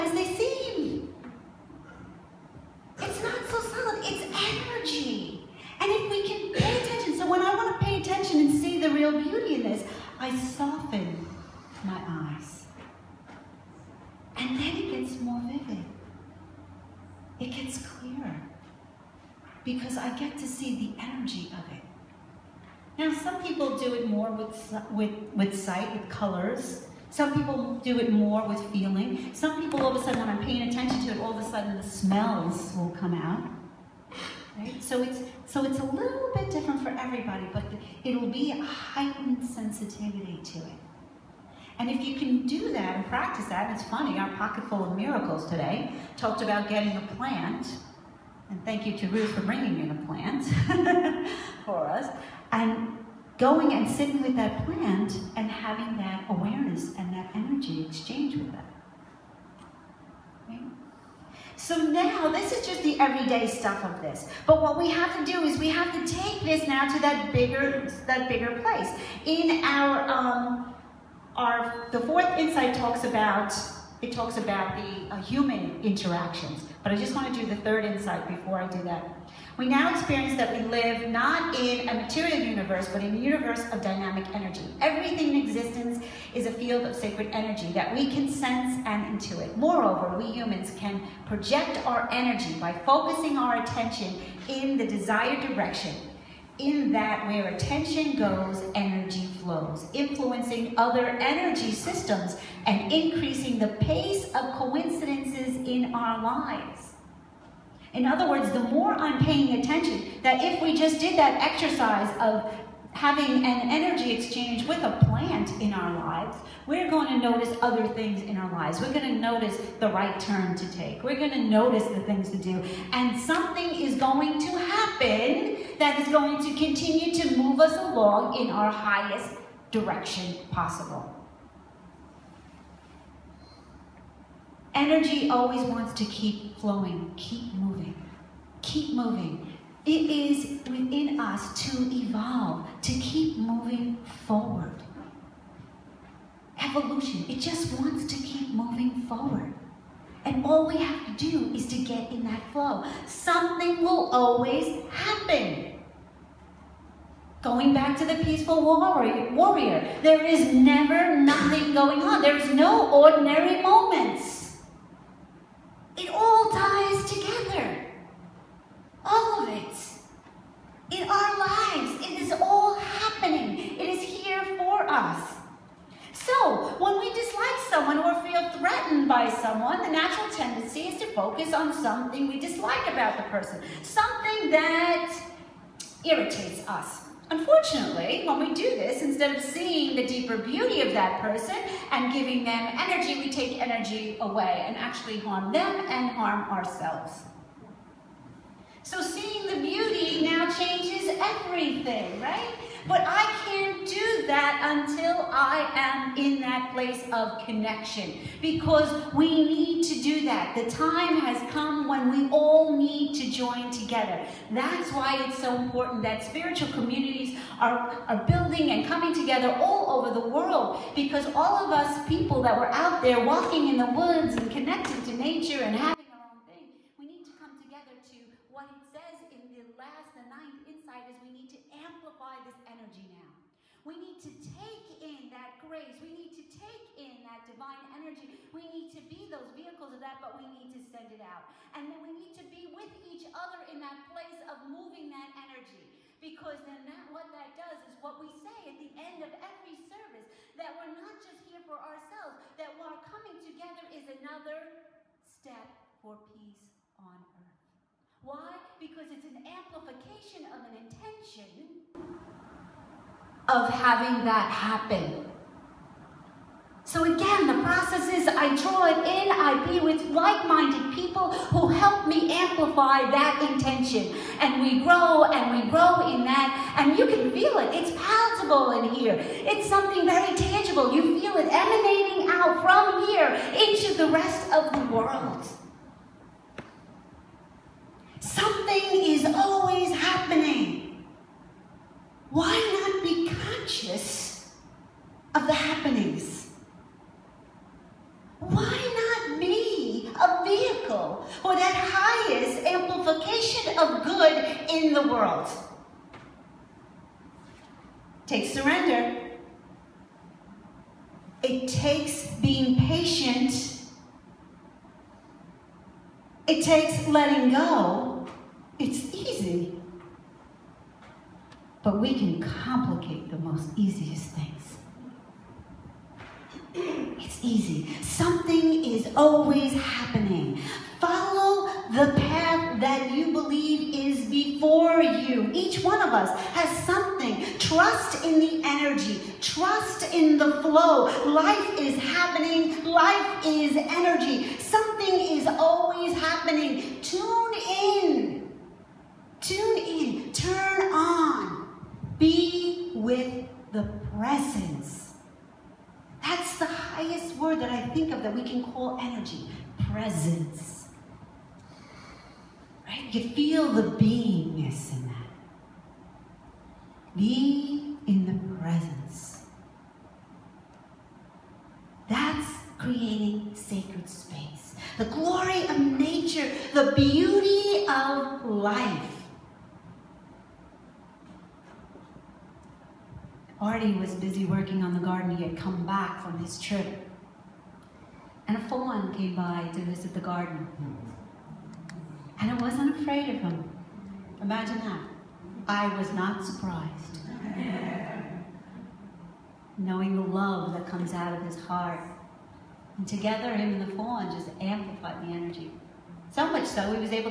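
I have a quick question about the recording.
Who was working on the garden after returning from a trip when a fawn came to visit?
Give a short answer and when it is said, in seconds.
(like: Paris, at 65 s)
Artie, at 383 s.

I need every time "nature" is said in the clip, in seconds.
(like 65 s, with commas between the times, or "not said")
225 s, 375 s.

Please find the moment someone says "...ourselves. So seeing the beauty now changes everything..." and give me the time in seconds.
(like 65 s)
196 s.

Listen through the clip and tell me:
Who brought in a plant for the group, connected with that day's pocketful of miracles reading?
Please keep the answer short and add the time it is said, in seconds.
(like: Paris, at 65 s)
Ruth, at 49 s.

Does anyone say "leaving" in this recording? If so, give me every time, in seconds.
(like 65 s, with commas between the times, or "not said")
not said.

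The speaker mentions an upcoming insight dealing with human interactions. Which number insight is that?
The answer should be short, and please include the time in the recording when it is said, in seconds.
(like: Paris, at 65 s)
fourth insight, at 71 s.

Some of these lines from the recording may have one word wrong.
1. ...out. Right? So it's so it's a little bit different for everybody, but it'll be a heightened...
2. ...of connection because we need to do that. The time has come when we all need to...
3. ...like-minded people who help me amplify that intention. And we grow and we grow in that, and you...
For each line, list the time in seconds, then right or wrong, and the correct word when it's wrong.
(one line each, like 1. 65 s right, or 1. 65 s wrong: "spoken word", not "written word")
1. 33 s right
2. 207 s right
3. 270 s right.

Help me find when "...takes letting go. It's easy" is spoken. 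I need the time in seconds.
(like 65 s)
316 s.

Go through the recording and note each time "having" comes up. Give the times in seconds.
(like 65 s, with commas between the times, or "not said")
55 s, 112 s, 225 s, 263 s.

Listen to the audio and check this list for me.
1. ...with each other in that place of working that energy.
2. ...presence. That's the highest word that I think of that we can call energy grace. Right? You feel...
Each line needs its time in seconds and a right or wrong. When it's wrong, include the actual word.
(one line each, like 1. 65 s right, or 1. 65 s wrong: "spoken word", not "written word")
1. 242 s wrong: "moving", not "working"
2. 354 s wrong: "presence", not "grace".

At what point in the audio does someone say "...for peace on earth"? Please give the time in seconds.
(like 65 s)
255 s.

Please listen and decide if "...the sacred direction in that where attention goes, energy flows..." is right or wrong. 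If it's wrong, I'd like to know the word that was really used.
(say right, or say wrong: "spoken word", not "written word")
wrong: "desired", not "sacred".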